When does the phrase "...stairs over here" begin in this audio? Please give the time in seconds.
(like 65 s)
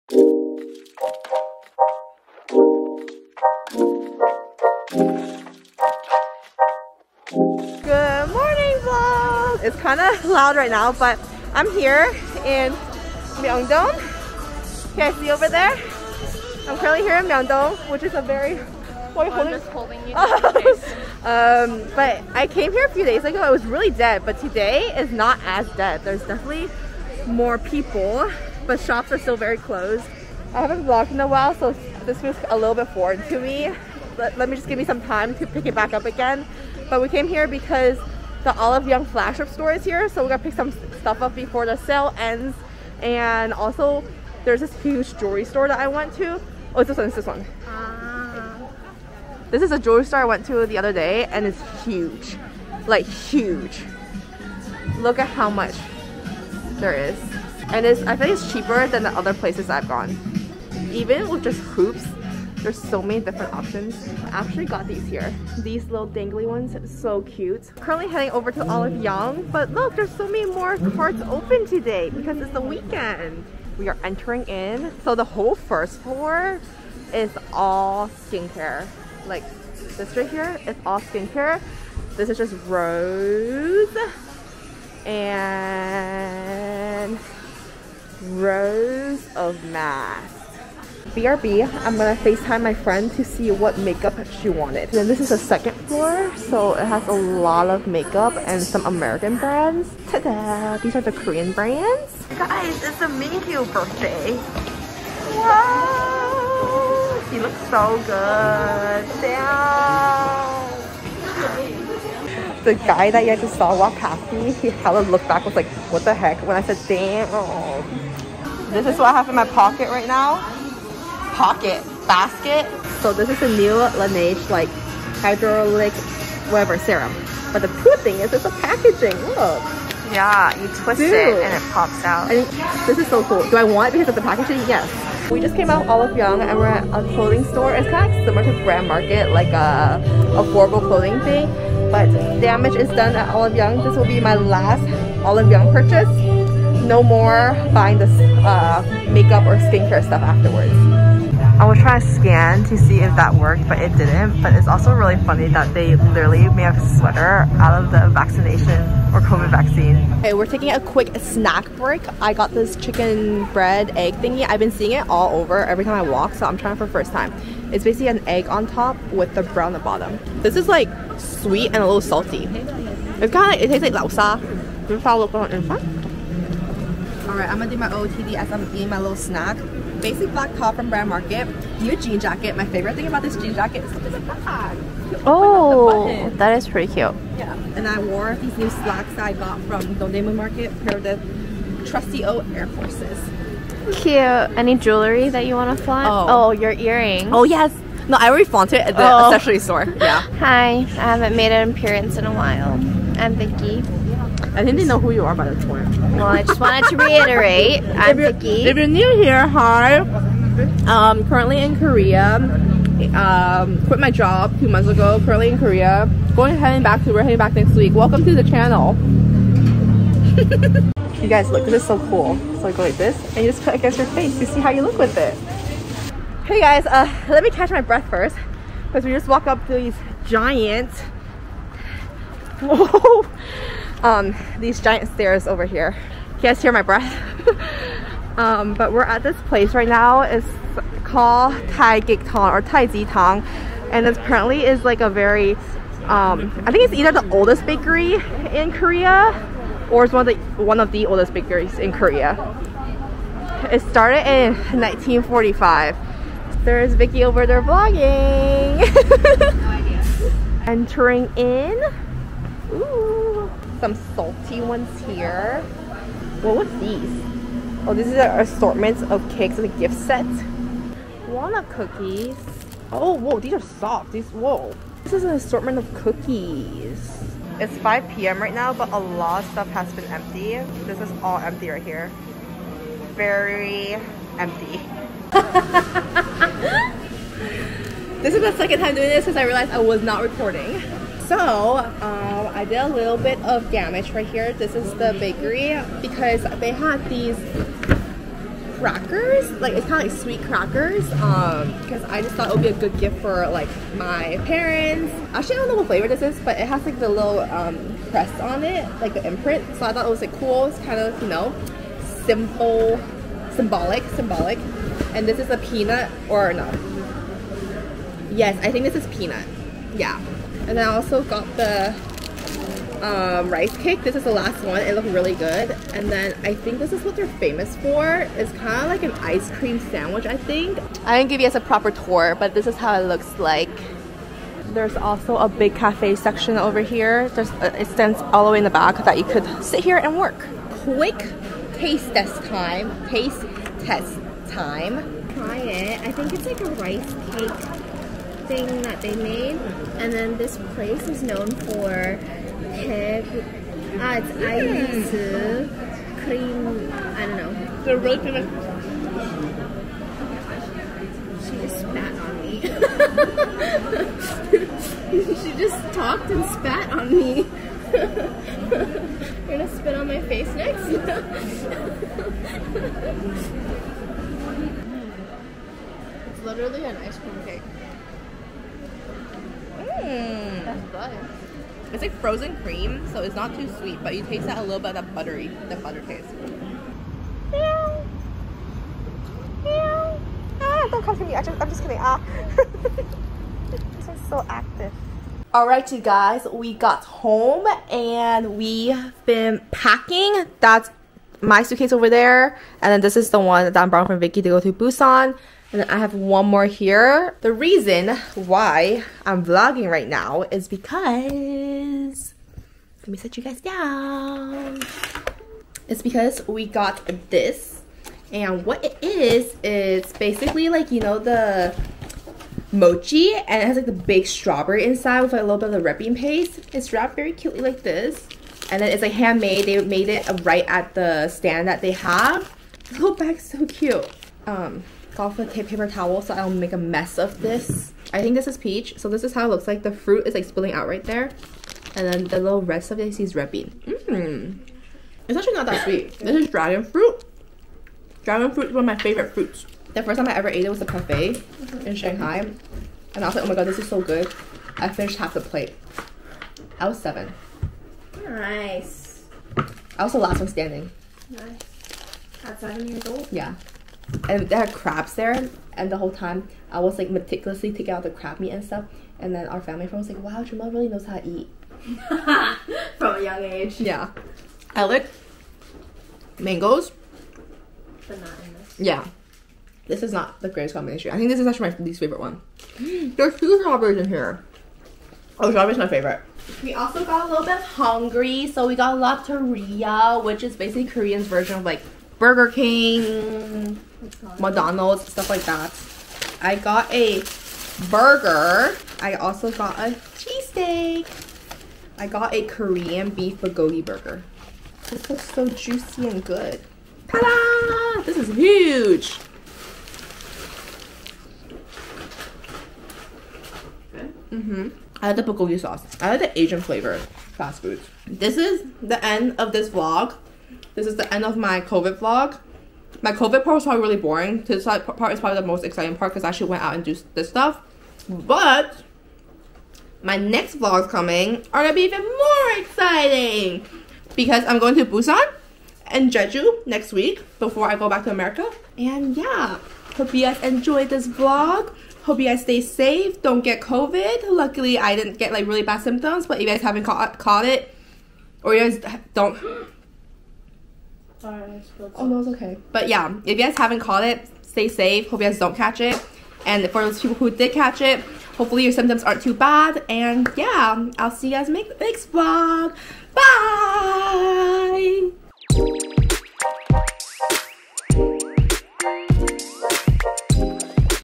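235 s.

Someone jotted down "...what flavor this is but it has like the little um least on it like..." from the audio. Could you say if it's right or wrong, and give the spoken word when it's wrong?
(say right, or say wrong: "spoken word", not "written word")
wrong: "crest", not "least".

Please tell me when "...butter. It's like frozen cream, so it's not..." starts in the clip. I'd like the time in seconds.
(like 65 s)
380 s.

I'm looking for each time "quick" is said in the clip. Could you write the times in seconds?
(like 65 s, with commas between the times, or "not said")
160 s, 340 s.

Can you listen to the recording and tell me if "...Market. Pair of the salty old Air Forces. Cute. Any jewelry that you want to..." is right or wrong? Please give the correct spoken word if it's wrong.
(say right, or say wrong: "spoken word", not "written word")
wrong: "trusty", not "salty".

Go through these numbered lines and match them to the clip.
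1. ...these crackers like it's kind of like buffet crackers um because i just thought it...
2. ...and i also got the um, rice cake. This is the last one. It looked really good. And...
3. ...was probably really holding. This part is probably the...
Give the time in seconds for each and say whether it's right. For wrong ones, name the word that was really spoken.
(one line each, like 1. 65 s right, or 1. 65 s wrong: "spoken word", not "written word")
1. 297 s wrong: "sweet", not "buffet"
2. 320 s right
3. 523 s wrong: "boring", not "holding".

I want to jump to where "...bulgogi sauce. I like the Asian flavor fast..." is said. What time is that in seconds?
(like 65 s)
515 s.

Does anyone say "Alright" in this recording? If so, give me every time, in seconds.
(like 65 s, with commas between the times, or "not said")
395 s, 551 s.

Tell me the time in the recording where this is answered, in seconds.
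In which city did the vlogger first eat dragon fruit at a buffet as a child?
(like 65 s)
451 s.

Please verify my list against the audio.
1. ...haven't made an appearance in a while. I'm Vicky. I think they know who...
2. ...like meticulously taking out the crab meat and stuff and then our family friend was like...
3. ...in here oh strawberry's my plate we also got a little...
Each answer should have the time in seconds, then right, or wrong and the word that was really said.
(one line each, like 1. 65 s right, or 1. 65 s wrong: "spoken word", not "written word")
1. 200 s right
2. 466 s right
3. 483 s wrong: "favorite", not "plate".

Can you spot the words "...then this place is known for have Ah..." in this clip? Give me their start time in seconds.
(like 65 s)
350 s.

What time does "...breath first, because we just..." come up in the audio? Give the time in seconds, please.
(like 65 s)
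227 s.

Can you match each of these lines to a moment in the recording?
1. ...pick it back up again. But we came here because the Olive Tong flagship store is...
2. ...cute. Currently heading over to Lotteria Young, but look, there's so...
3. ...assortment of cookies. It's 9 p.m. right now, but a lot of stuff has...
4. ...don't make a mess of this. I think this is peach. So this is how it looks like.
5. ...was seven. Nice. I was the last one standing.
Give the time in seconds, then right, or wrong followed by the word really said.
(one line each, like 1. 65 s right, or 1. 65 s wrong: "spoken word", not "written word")
1. 35 s wrong: "Young", not "Tong"
2. 67 s wrong: "Olive", not "Lotteria"
3. 275 s wrong: "5", not "9"
4. 436 s right
5. 456 s right.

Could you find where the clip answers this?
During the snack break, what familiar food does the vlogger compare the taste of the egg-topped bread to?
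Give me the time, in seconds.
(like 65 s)
173 s.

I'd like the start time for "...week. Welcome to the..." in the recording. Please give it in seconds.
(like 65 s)
217 s.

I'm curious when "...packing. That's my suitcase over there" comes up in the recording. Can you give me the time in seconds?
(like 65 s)
399 s.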